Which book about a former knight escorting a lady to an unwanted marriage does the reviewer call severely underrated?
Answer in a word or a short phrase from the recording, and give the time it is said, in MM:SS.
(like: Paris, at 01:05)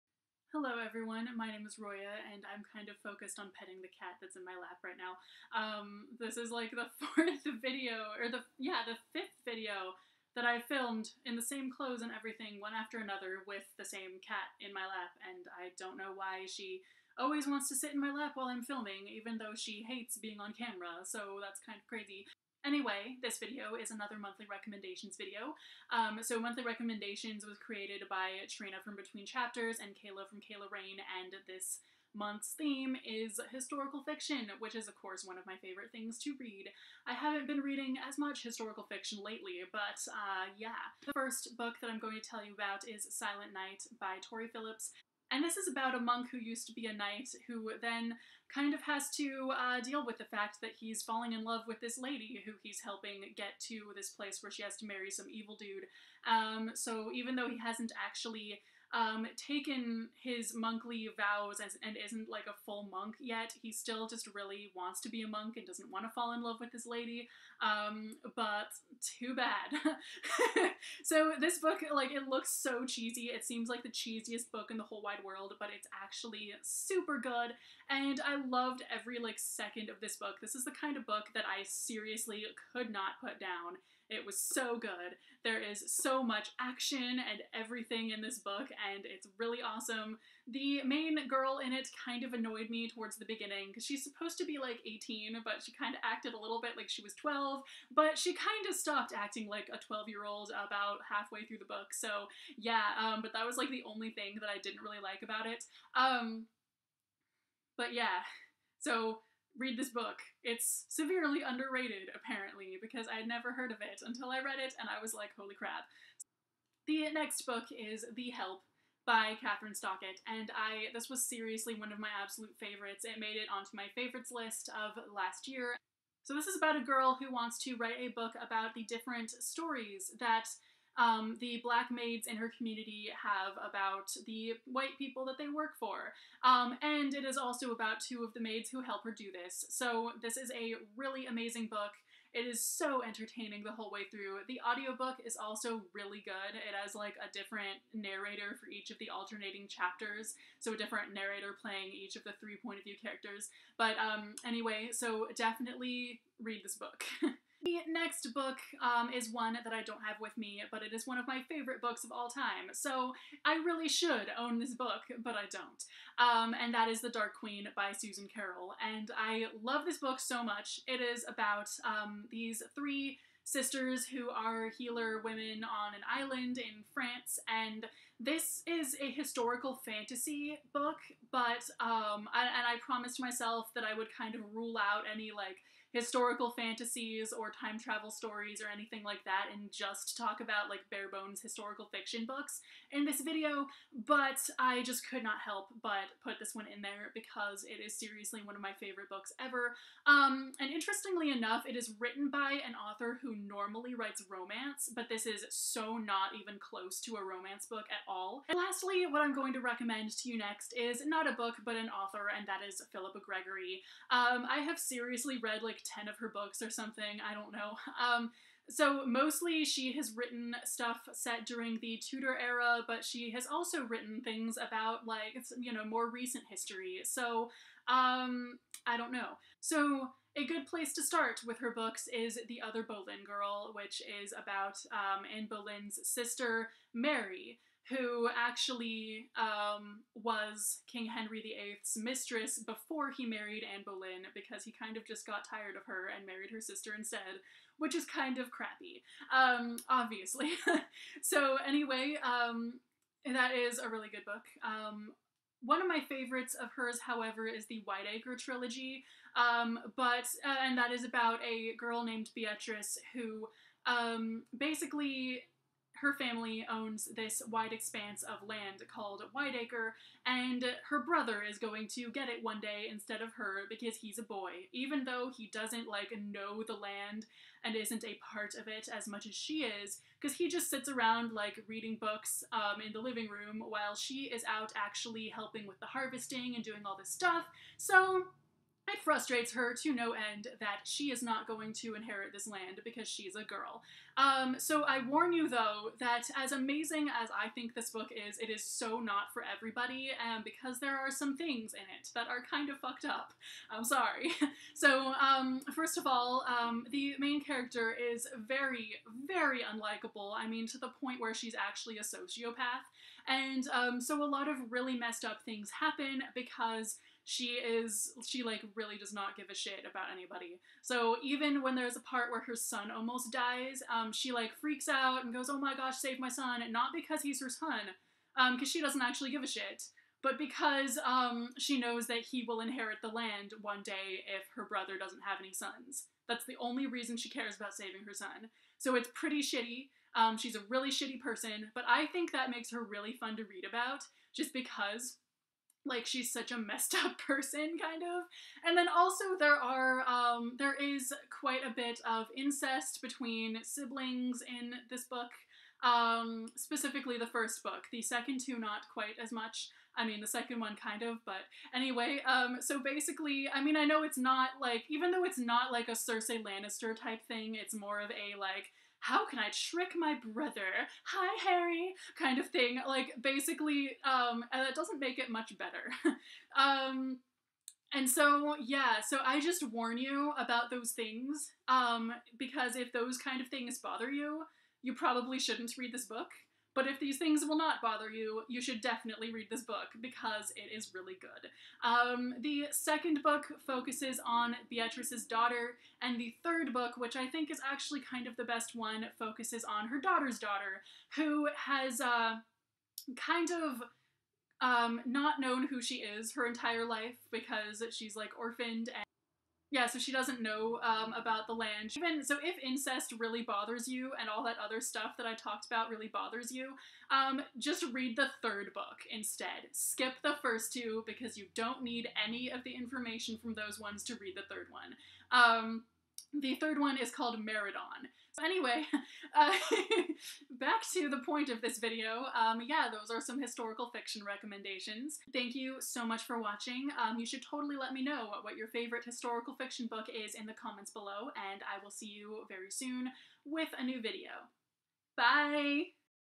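Silent Knight, at 00:43.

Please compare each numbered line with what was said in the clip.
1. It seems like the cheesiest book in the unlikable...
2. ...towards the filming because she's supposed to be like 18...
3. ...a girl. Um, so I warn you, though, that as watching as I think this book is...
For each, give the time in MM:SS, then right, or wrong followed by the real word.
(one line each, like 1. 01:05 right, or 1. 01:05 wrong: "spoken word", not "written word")
1. 01:13 wrong: "whole", not "unlikable"
2. 01:32 wrong: "beginning", not "filming"
3. 04:53 wrong: "amazing", not "watching".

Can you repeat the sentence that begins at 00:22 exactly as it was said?
Anyway, this video is another monthly recommendations video.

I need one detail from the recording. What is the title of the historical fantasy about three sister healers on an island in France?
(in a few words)
The Dark Queen.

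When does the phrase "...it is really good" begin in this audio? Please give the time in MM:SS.
06:30.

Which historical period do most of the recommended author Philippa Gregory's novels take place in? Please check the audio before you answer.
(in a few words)
Tudor era.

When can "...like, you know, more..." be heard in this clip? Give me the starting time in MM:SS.
03:45.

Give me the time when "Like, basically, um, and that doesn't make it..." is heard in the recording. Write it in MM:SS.
06:12.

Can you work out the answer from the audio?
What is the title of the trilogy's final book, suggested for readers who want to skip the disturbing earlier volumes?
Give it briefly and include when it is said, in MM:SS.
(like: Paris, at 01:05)
Meridon, at 07:07.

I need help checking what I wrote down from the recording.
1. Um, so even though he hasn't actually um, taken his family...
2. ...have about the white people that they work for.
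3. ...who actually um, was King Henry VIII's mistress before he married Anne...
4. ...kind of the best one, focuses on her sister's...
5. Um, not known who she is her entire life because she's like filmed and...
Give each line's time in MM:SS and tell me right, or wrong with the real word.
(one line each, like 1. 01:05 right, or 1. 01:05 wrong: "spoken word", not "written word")
1. 00:56 wrong: "monkly", not "family"
2. 02:13 right
3. 03:57 right
4. 06:38 wrong: "daughter", not "sister"
5. 06:44 wrong: "orphaned", not "filmed".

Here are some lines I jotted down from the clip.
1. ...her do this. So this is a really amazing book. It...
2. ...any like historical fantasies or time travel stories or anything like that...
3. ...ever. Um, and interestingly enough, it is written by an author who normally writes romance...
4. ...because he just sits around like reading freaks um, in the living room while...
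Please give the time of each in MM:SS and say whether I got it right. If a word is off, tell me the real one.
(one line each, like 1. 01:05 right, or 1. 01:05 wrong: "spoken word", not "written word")
1. 02:19 right
2. 03:05 right
3. 03:19 right
4. 04:40 wrong: "books", not "freaks".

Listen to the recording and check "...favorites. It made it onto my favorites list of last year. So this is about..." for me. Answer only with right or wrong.
right.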